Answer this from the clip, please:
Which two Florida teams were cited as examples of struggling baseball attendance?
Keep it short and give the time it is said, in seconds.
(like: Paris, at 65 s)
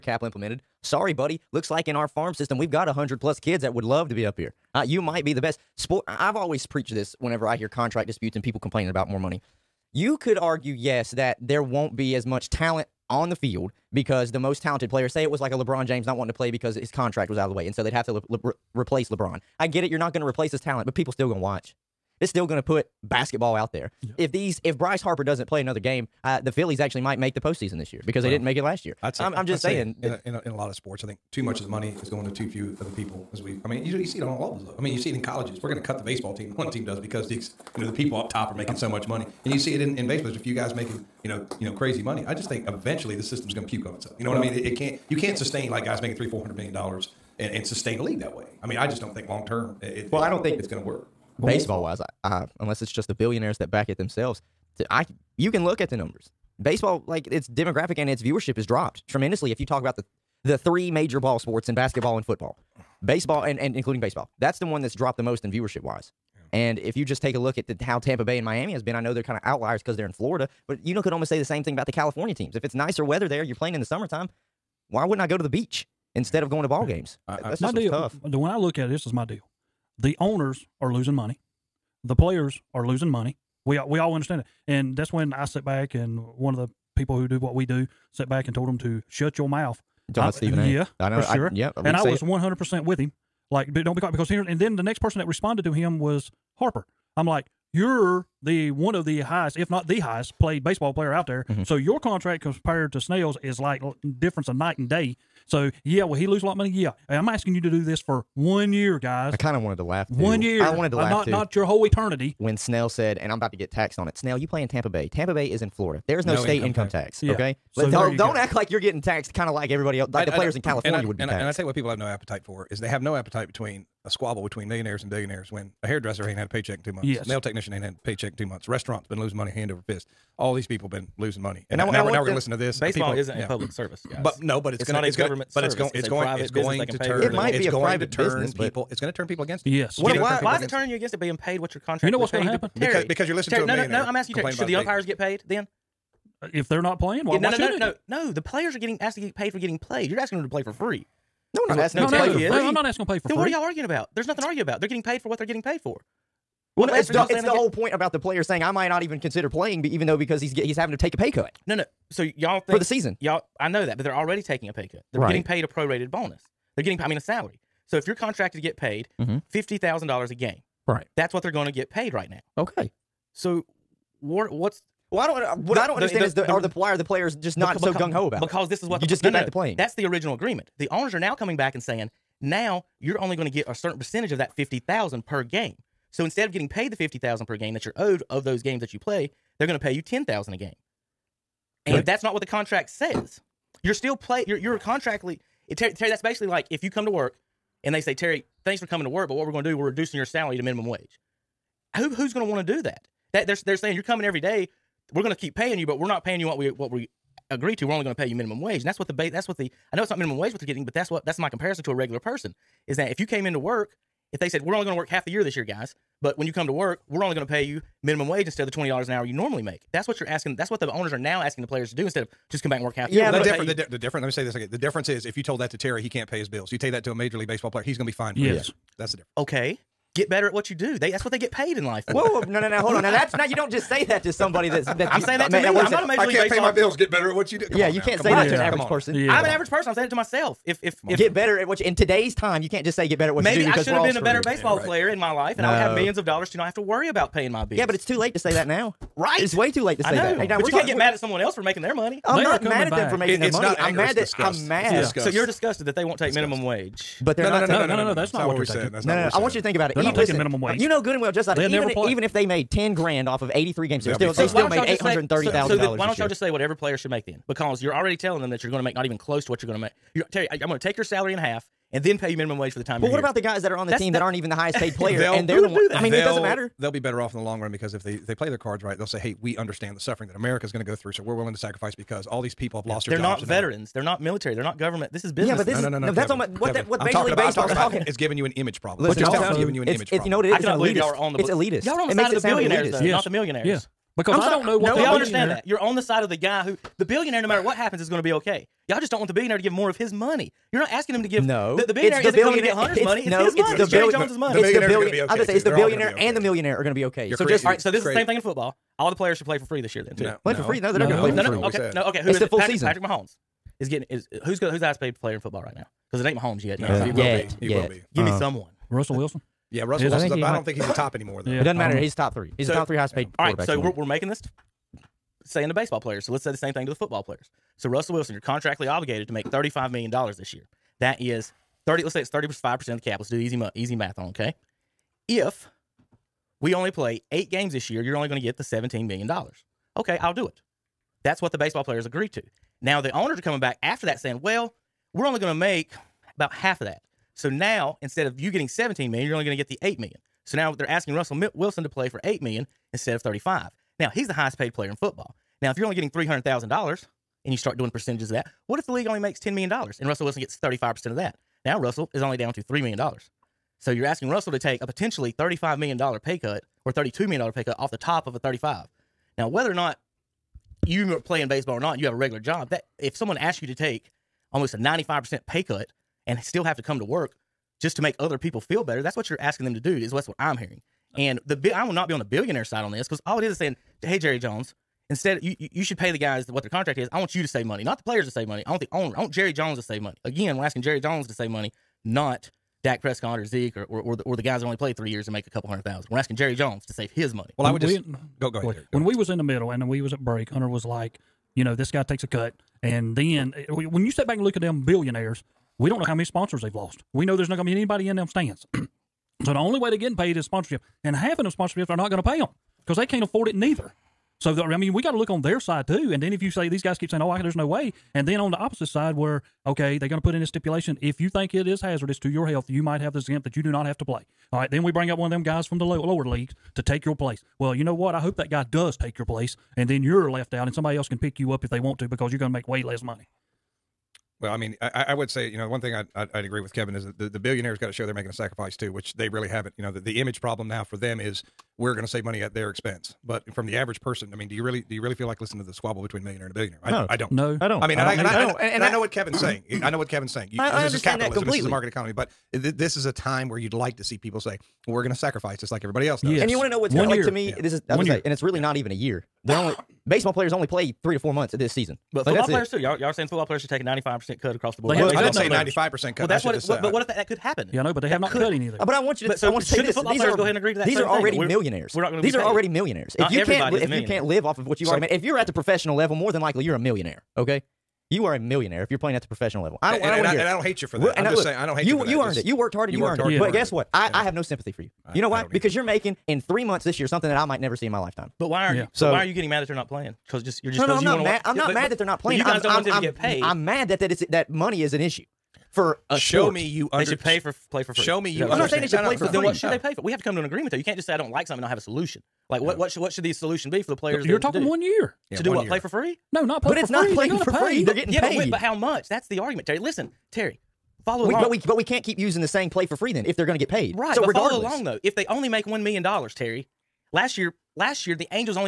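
Tampa Bay and Miami, at 67 s.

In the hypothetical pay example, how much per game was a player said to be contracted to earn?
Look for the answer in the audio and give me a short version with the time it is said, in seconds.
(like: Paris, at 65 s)
$50,000, at 169 s.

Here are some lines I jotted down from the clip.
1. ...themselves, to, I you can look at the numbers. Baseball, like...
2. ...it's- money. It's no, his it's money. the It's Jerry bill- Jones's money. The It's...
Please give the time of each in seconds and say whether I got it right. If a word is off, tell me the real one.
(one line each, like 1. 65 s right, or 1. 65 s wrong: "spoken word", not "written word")
1. 53 s right
2. 302 s right.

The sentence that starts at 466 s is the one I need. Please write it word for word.
It, what but uh, what if that, that, could happen?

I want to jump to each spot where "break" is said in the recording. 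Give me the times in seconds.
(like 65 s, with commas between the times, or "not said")
400 s.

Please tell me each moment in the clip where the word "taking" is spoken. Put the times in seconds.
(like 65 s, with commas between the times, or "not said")
164 s, 260 s.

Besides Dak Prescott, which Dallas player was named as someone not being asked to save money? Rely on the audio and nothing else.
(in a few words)
Zeke.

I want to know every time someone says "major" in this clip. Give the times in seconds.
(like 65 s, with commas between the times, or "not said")
60 s, 227 s, 236 s, 287 s.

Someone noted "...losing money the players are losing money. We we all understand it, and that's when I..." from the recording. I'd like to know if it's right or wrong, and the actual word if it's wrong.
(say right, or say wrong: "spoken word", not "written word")
right.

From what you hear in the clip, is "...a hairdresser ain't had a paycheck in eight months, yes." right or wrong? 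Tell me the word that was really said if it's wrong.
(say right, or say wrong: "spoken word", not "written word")
wrong: "two", not "eight".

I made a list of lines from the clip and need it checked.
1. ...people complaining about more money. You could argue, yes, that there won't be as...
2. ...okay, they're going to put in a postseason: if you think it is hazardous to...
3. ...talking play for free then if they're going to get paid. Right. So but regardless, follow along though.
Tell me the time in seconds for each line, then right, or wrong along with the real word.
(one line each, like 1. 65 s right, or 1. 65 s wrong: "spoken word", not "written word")
1. 8 s right
2. 419 s wrong: "stipulation", not "postseason"
3. 512 s wrong: "saying", not "talking".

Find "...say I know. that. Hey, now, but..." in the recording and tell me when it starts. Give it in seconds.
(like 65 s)
250 s.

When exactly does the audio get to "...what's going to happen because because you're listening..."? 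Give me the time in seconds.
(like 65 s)
142 s.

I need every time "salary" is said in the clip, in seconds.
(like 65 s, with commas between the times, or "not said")
167 s, 200 s, 271 s.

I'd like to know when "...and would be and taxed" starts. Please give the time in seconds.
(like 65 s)
120 s.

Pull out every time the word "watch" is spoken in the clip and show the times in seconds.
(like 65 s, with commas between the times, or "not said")
21 s, 491 s.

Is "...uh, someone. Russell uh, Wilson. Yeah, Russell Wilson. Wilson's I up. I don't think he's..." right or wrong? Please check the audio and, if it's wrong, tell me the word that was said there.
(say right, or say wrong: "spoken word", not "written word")
right.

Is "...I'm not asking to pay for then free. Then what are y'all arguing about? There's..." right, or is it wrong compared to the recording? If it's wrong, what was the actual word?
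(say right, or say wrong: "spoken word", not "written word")
right.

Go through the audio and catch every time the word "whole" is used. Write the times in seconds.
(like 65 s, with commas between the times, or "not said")
111 s, 157 s.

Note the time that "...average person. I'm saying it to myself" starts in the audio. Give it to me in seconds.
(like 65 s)
239 s.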